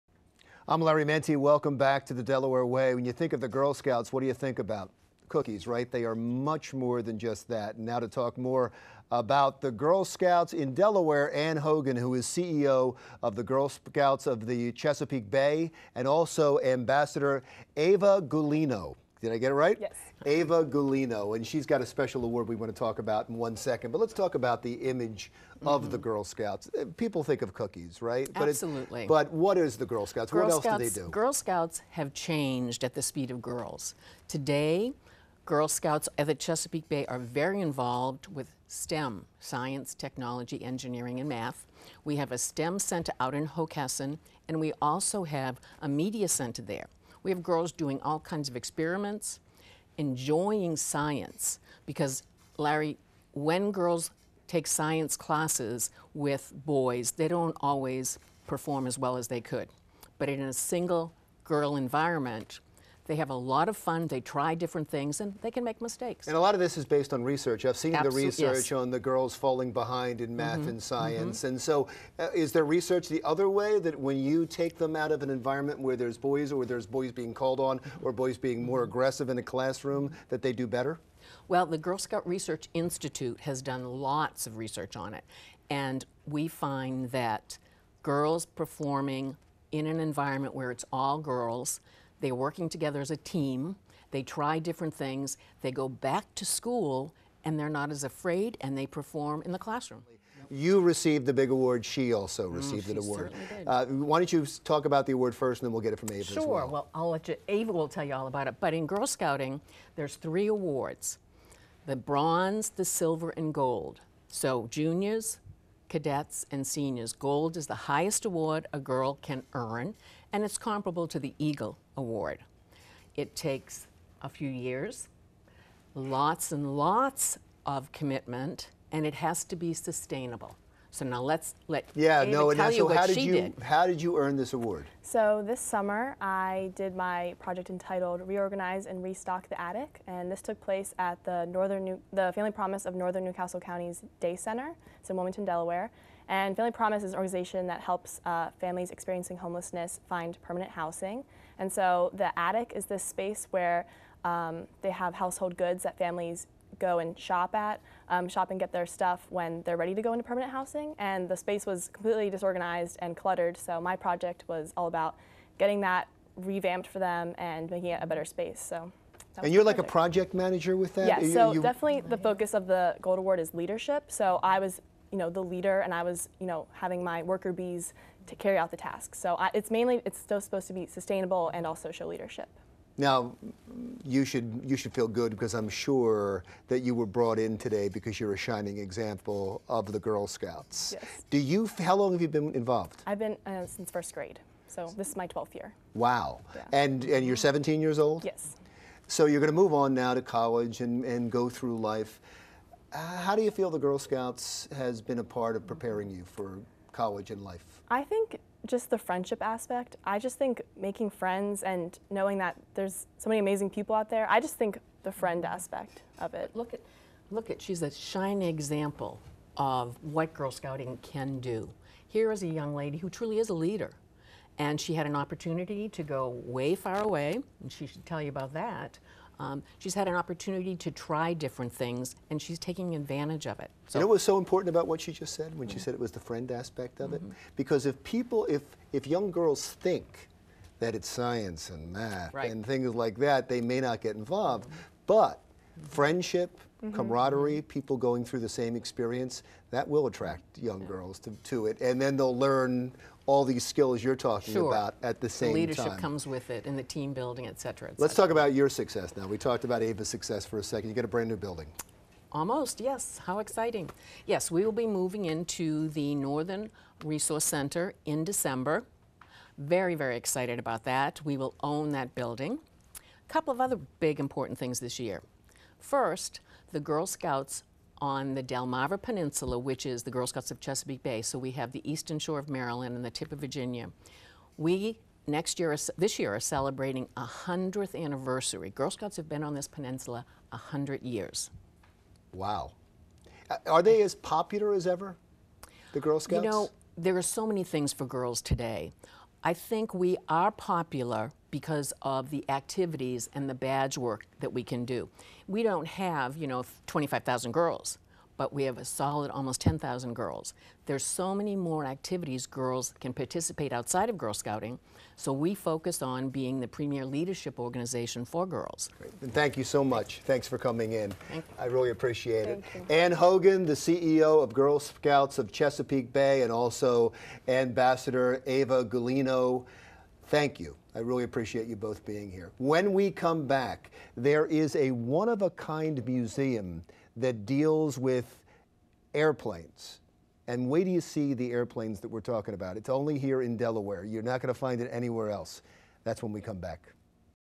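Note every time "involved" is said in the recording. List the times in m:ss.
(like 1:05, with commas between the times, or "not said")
0:37, 3:12, 4:04.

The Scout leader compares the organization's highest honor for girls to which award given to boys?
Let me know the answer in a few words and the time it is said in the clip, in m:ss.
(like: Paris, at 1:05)
Eagle Award, at 2:01.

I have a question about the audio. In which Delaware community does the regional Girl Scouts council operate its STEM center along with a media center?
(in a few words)
Hockessin.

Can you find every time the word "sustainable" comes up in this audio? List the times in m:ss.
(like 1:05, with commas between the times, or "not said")
2:09, 3:00.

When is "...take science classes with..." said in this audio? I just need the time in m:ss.
0:54.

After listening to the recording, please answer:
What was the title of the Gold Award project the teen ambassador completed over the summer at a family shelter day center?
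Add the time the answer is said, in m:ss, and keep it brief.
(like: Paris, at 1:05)
Reorganize and Restock the Attic, at 2:18.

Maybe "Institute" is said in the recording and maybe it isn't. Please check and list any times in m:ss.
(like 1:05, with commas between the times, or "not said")
1:22.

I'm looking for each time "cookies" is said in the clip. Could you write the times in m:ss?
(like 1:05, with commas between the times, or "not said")
0:05, 0:27.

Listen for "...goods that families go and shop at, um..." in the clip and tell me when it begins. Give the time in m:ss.
2:35.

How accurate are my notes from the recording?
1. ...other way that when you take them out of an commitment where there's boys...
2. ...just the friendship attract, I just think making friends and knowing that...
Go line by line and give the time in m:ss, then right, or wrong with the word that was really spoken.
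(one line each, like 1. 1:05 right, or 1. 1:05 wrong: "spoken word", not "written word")
1. 1:13 wrong: "environment", not "commitment"
2. 3:28 wrong: "aspect", not "attract".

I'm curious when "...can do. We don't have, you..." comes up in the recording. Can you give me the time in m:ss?
5:04.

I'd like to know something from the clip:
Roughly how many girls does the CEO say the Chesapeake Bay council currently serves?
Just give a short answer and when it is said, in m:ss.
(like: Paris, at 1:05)
10,000, at 5:09.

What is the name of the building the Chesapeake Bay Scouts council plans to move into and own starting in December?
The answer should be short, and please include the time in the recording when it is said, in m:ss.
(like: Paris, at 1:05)
Northern Resource Center, at 4:26.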